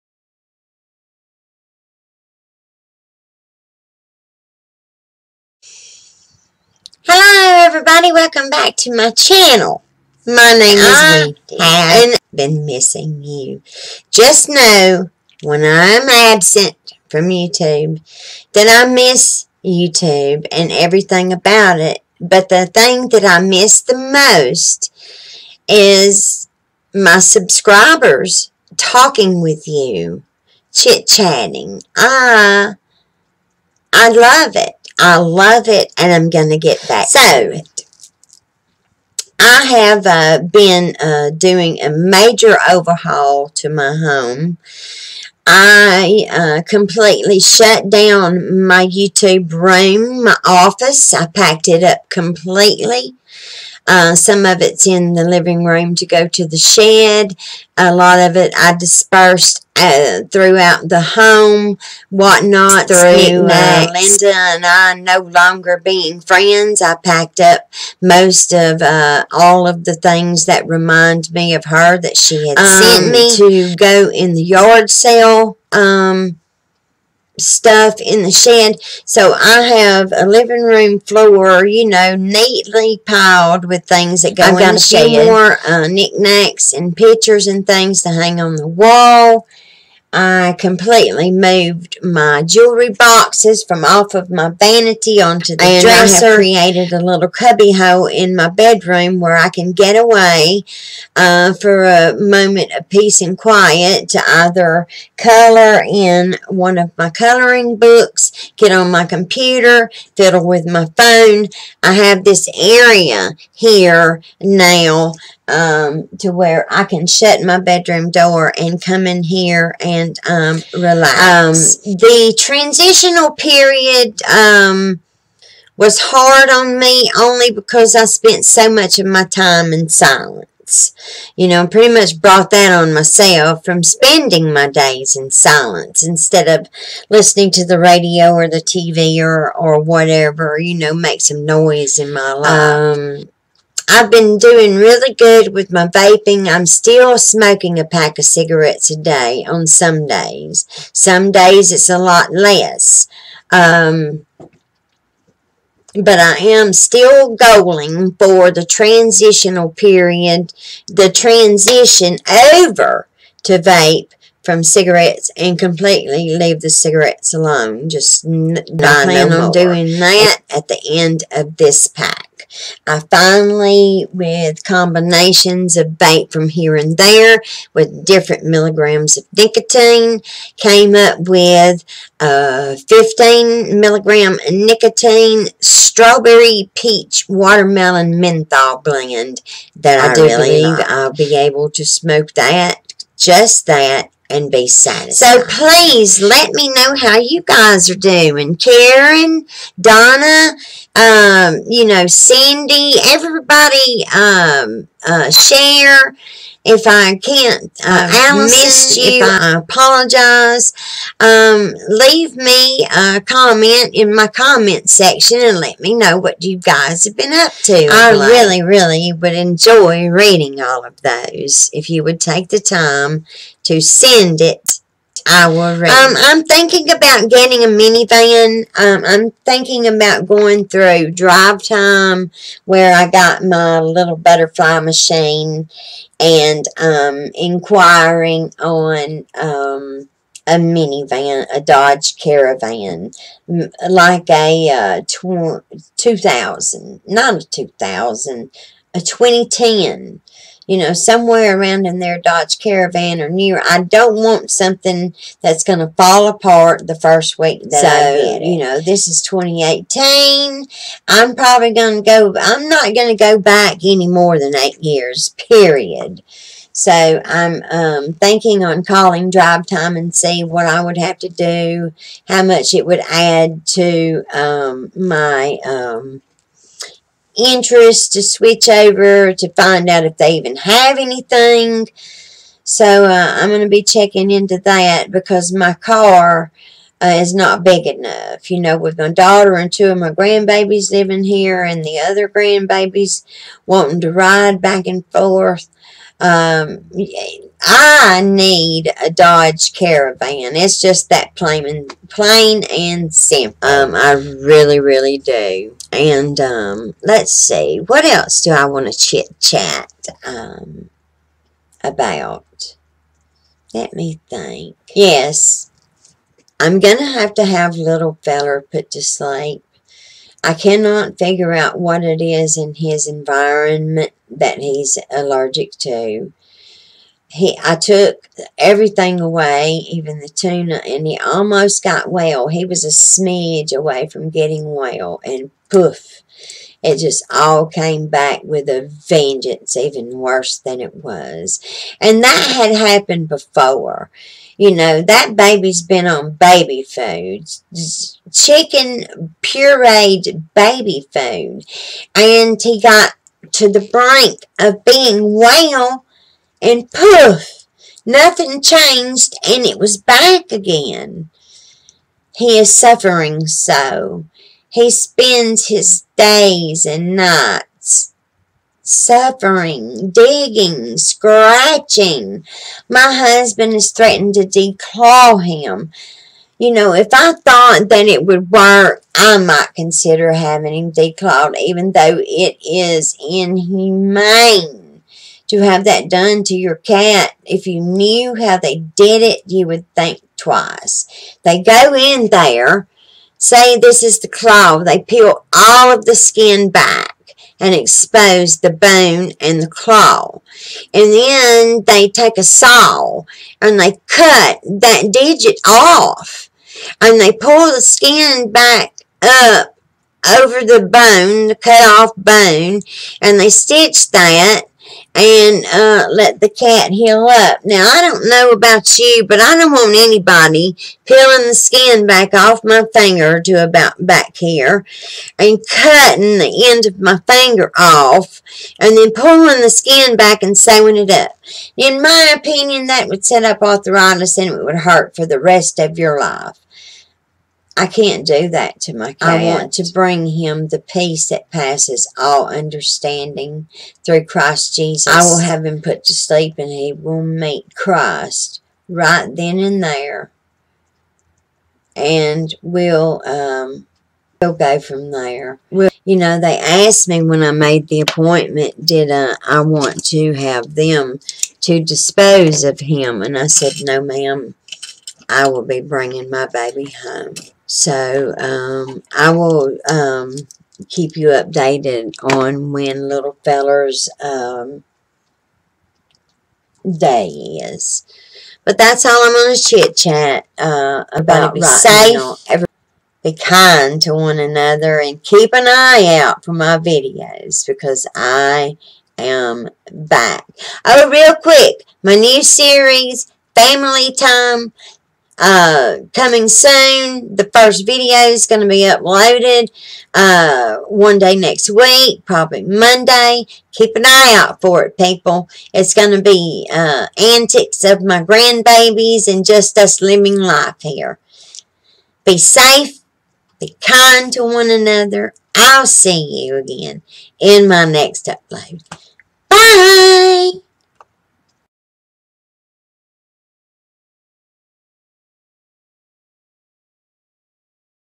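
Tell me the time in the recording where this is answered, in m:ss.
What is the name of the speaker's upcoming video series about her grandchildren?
8:13.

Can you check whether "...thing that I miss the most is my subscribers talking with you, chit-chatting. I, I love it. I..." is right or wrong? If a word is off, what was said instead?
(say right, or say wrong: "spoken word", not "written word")
right.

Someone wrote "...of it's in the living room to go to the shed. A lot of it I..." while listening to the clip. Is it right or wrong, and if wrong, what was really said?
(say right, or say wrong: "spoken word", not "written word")
right.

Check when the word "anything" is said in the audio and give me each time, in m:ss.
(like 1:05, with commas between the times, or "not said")
4:40.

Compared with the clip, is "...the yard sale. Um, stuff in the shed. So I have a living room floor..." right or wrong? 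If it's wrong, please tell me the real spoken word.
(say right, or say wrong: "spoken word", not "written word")
right.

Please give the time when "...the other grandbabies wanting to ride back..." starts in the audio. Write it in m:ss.
4:51.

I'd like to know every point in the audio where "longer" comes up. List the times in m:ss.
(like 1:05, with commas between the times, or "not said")
1:05.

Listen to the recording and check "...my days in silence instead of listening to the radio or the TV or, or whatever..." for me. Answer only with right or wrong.
right.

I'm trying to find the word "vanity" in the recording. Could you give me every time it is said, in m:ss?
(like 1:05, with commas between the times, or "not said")
1:34.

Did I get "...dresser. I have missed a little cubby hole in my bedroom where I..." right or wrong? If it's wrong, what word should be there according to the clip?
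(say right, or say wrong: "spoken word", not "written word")
wrong: "created", not "missed".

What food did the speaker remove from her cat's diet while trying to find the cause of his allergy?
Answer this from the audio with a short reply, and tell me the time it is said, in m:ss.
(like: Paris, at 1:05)
Tuna, at 5:30.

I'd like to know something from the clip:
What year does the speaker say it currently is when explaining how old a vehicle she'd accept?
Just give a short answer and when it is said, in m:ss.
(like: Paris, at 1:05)
2018, at 4:19.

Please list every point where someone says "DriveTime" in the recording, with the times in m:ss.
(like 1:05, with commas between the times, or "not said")
3:51, 4:29.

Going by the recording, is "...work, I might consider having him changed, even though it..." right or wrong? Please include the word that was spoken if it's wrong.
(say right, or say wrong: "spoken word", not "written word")
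wrong: "declawed", not "changed".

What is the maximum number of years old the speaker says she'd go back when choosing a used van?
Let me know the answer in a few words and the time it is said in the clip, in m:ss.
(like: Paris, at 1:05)
8, at 4:24.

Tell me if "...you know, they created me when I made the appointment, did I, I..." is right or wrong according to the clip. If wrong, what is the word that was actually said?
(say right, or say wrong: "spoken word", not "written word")
wrong: "asked", not "created".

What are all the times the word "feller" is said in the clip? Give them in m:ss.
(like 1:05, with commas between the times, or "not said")
5:18, 7:53.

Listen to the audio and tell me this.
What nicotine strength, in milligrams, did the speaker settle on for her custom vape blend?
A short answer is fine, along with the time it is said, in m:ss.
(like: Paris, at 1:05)
15 milligrams, at 3:02.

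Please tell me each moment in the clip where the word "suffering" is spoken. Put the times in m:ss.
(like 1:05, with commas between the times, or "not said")
6:02, 6:08.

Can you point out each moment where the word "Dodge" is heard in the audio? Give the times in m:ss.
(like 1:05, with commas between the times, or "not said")
4:01, 4:12, 4:59.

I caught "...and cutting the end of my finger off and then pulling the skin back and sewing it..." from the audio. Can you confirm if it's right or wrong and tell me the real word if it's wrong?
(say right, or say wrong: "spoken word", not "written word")
right.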